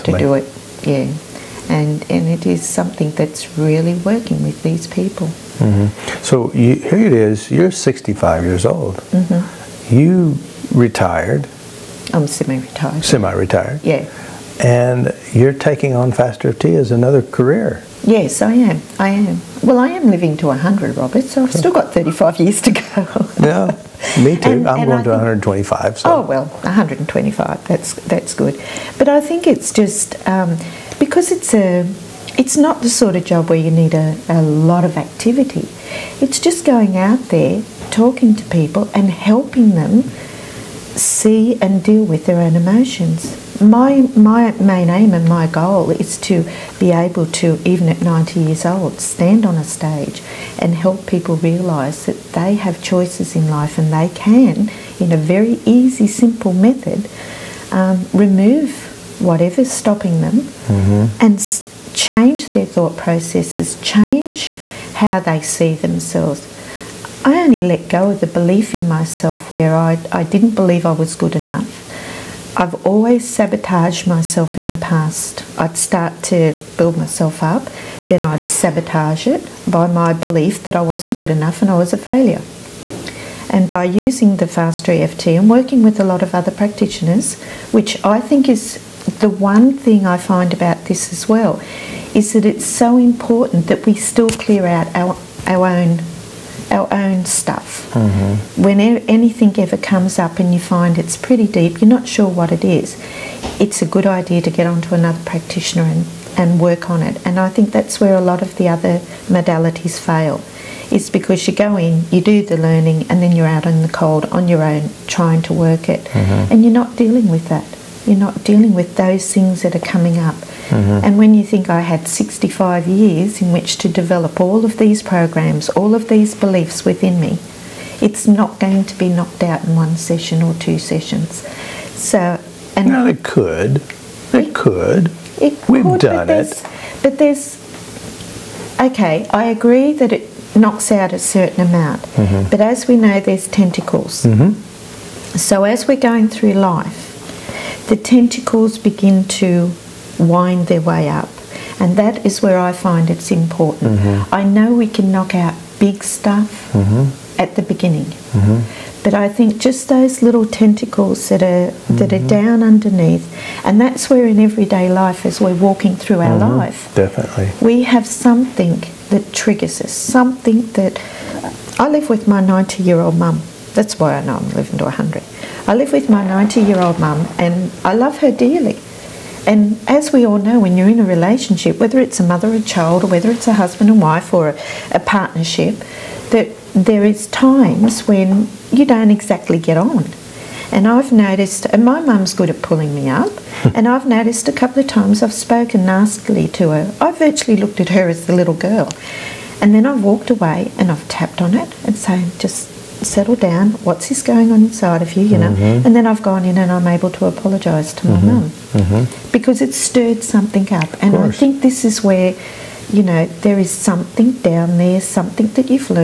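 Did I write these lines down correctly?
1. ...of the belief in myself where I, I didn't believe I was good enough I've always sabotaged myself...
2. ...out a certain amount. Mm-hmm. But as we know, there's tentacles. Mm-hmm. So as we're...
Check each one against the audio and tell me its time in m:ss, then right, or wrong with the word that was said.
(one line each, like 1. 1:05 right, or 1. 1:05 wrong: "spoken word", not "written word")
1. 1:08 right
2. 2:20 right.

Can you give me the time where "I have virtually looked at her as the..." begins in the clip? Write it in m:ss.
3:17.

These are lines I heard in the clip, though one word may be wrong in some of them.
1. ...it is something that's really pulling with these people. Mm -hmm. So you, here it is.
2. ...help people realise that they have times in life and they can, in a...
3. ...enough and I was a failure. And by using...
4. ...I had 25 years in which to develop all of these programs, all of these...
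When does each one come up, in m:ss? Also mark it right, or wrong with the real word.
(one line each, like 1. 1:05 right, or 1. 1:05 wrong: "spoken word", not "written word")
1. 0:02 wrong: "working", not "pulling"
2. 0:50 wrong: "choices", not "times"
3. 1:21 right
4. 2:01 wrong: "65", not "25".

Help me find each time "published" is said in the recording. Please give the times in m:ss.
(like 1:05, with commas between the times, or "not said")
not said.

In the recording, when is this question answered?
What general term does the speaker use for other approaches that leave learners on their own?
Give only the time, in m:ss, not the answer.
1:49.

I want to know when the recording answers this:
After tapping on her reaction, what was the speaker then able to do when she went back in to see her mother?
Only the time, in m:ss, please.
3:27.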